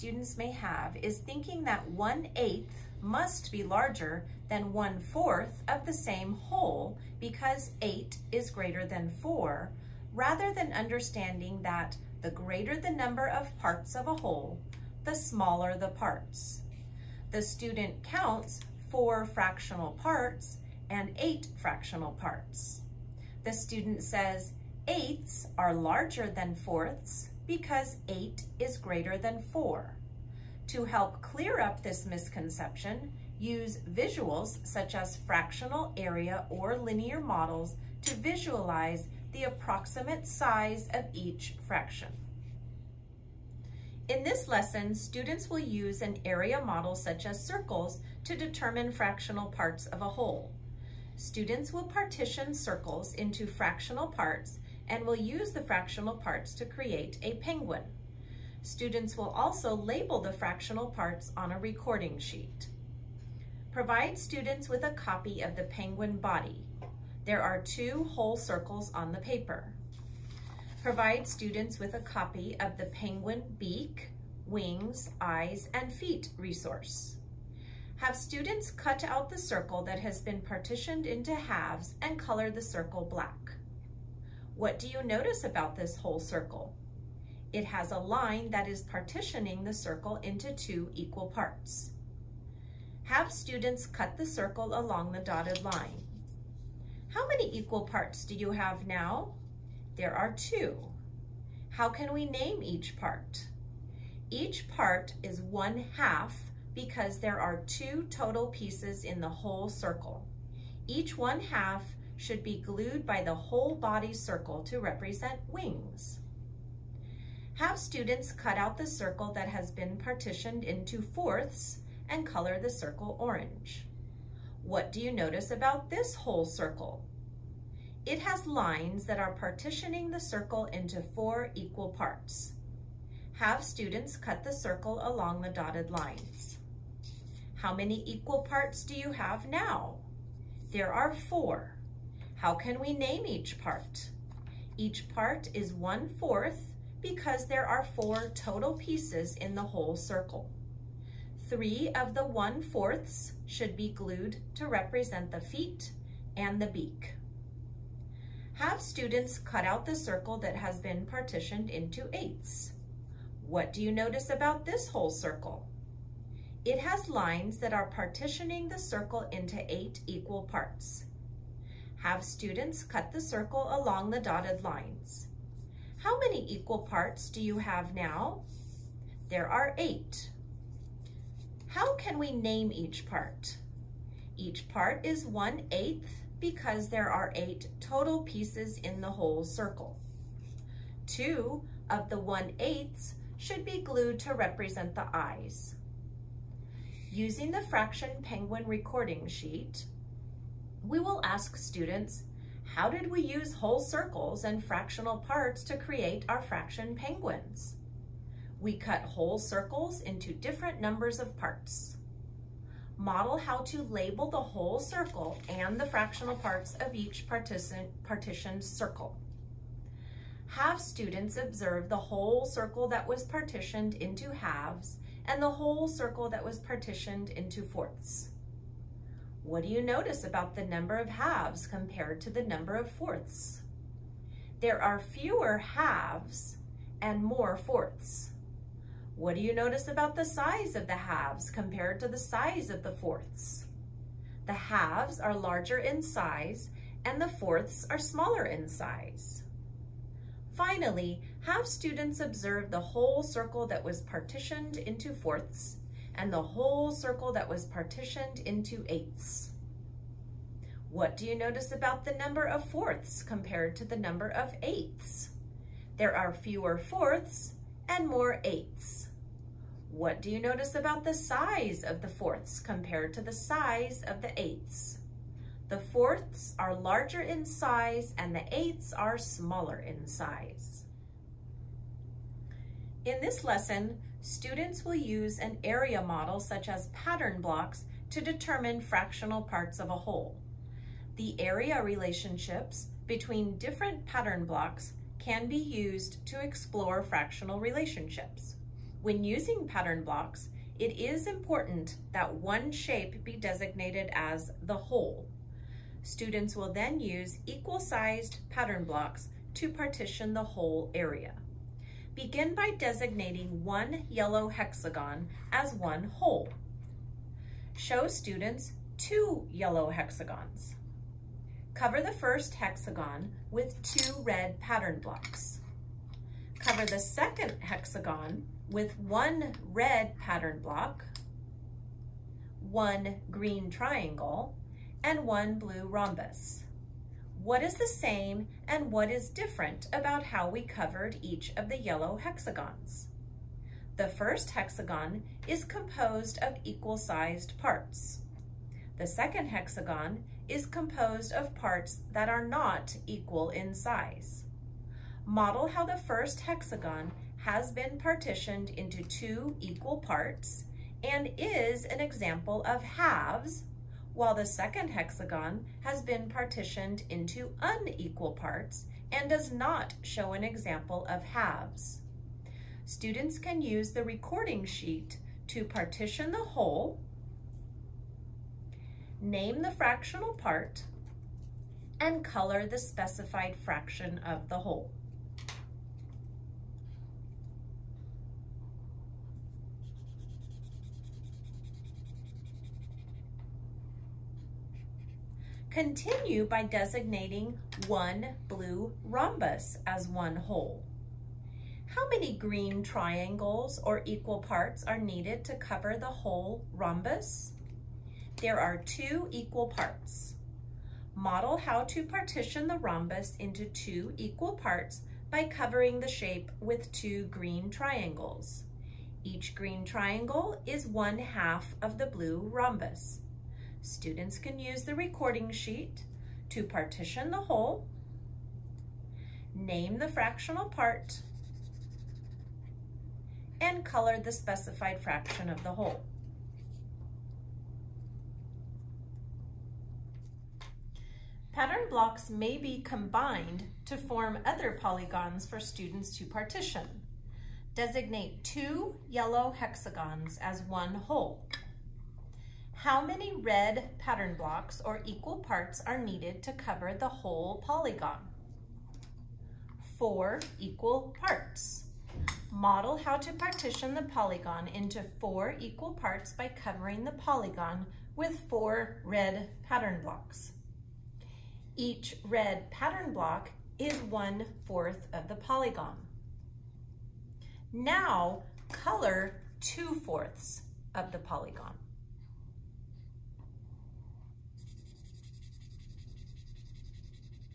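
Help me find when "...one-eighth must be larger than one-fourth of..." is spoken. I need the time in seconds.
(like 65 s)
1 s.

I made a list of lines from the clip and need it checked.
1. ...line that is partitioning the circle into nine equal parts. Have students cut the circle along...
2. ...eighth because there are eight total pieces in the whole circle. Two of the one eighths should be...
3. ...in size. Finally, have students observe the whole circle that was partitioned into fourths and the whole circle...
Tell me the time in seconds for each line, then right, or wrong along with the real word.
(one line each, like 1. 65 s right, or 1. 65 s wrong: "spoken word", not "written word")
1. 87 s wrong: "two", not "nine"
2. 185 s right
3. 248 s right.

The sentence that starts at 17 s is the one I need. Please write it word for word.
The student counts 4 fractional parts and 8 fractional parts.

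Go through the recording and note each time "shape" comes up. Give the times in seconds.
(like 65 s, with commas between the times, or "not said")
302 s, 416 s.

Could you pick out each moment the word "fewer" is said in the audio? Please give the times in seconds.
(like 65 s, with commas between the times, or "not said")
234 s, 266 s.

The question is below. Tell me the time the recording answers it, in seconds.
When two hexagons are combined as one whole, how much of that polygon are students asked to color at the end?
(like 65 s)
479 s.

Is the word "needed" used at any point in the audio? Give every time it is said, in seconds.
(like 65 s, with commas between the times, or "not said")
404 s, 455 s.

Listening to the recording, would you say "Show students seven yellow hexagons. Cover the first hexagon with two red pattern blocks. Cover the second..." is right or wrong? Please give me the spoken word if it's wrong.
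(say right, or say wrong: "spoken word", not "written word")
wrong: "two", not "seven".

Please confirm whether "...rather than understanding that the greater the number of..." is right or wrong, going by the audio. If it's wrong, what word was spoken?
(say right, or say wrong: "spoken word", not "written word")
right.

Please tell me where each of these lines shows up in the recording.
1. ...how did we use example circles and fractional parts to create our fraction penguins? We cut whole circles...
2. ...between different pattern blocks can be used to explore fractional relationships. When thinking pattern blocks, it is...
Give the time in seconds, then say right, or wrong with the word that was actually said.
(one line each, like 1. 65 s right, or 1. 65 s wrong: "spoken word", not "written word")
1. 202 s wrong: "whole", not "example"
2. 293 s wrong: "using", not "thinking".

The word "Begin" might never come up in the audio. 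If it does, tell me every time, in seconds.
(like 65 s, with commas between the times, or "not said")
312 s.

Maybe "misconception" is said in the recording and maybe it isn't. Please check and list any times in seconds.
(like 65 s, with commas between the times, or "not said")
32 s.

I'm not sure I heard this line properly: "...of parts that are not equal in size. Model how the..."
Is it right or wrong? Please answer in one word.
right.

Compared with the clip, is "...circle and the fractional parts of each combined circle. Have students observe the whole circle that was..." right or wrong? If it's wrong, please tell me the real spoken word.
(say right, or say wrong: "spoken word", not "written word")
wrong: "partitioned", not "combined".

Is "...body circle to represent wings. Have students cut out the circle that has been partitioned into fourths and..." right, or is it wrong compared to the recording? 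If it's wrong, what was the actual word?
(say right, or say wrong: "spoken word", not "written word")
right.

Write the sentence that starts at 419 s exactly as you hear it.
Each green triangle is one half of the blue rhombus.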